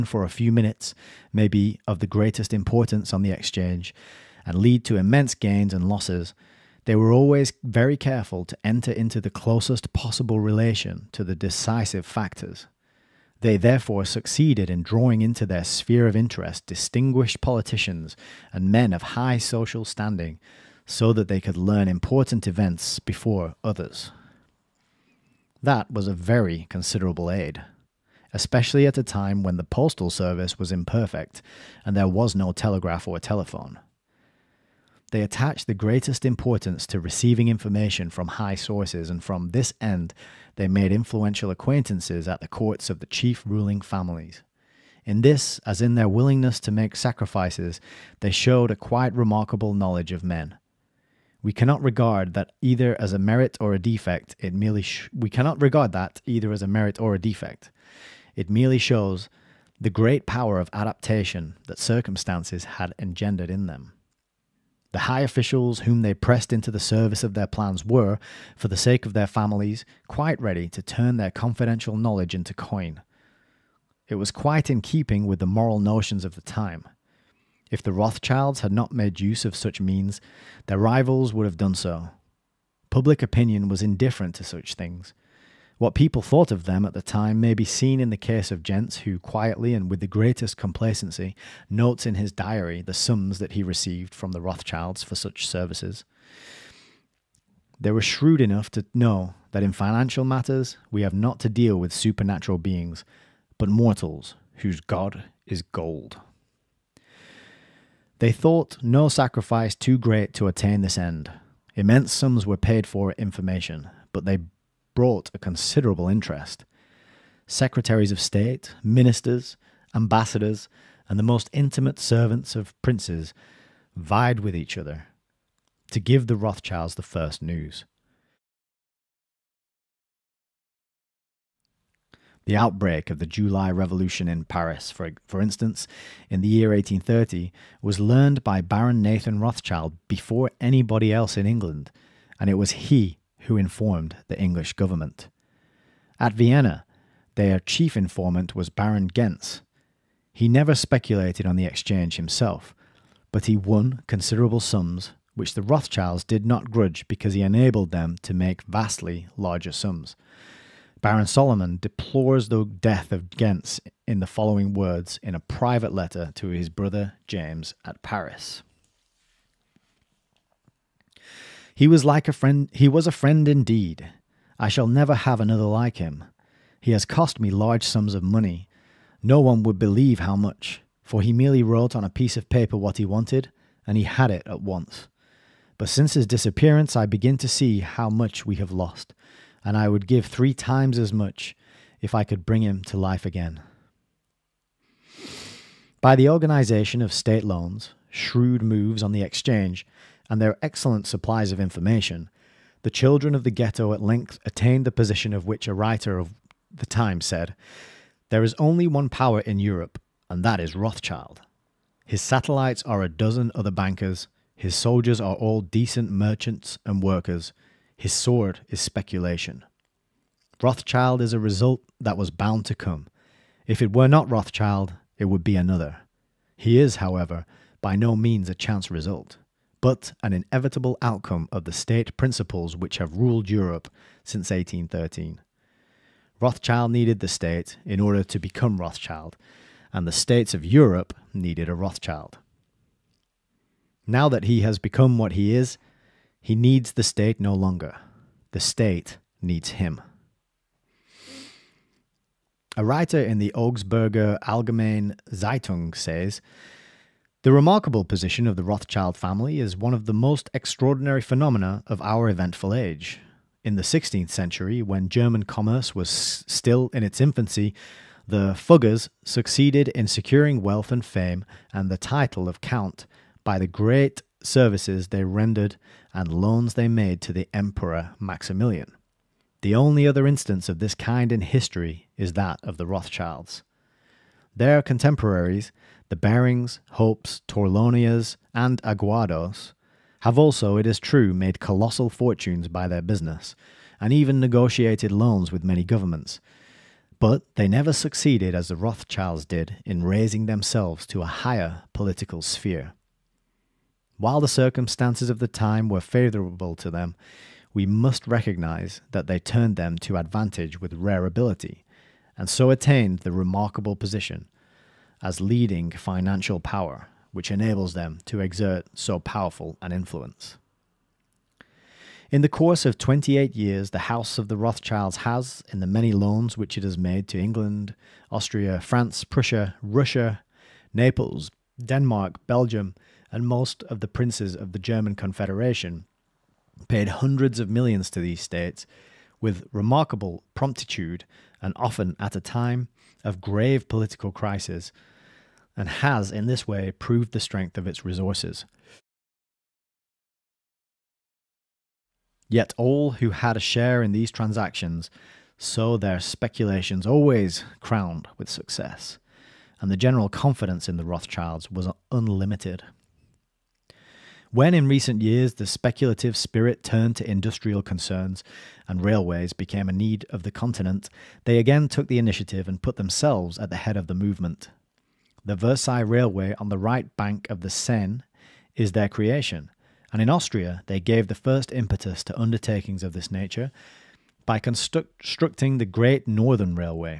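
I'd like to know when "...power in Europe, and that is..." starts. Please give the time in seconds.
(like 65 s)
209 s.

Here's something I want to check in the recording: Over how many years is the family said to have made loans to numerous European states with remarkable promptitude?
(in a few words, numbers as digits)
28.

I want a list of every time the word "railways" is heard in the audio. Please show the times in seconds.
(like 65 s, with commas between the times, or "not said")
369 s, 375 s.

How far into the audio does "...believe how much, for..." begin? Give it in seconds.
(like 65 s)
179 s.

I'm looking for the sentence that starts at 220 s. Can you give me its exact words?
Rothschild is a result that was bound to come.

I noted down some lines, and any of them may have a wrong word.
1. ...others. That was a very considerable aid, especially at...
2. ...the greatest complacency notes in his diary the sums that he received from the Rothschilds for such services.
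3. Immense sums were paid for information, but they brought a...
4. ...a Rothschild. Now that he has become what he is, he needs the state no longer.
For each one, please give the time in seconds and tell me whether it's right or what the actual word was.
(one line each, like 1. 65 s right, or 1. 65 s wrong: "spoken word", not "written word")
1. 23 s right
2. 89 s right
3. 111 s right
4. 241 s right.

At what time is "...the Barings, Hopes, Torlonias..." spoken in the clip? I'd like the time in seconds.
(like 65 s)
286 s.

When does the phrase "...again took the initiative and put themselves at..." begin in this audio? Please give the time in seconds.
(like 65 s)
371 s.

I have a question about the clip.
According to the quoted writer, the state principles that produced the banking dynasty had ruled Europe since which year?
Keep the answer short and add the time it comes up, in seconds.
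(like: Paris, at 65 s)
1813, at 234 s.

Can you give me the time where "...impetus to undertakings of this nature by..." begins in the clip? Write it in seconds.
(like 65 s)
381 s.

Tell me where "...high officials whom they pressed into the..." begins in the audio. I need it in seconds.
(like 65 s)
64 s.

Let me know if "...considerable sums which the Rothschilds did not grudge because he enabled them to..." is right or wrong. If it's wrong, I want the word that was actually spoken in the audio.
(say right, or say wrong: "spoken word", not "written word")
right.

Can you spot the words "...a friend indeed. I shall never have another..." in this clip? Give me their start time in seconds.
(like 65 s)
173 s.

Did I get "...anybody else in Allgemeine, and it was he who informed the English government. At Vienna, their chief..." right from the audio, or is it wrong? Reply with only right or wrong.
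wrong.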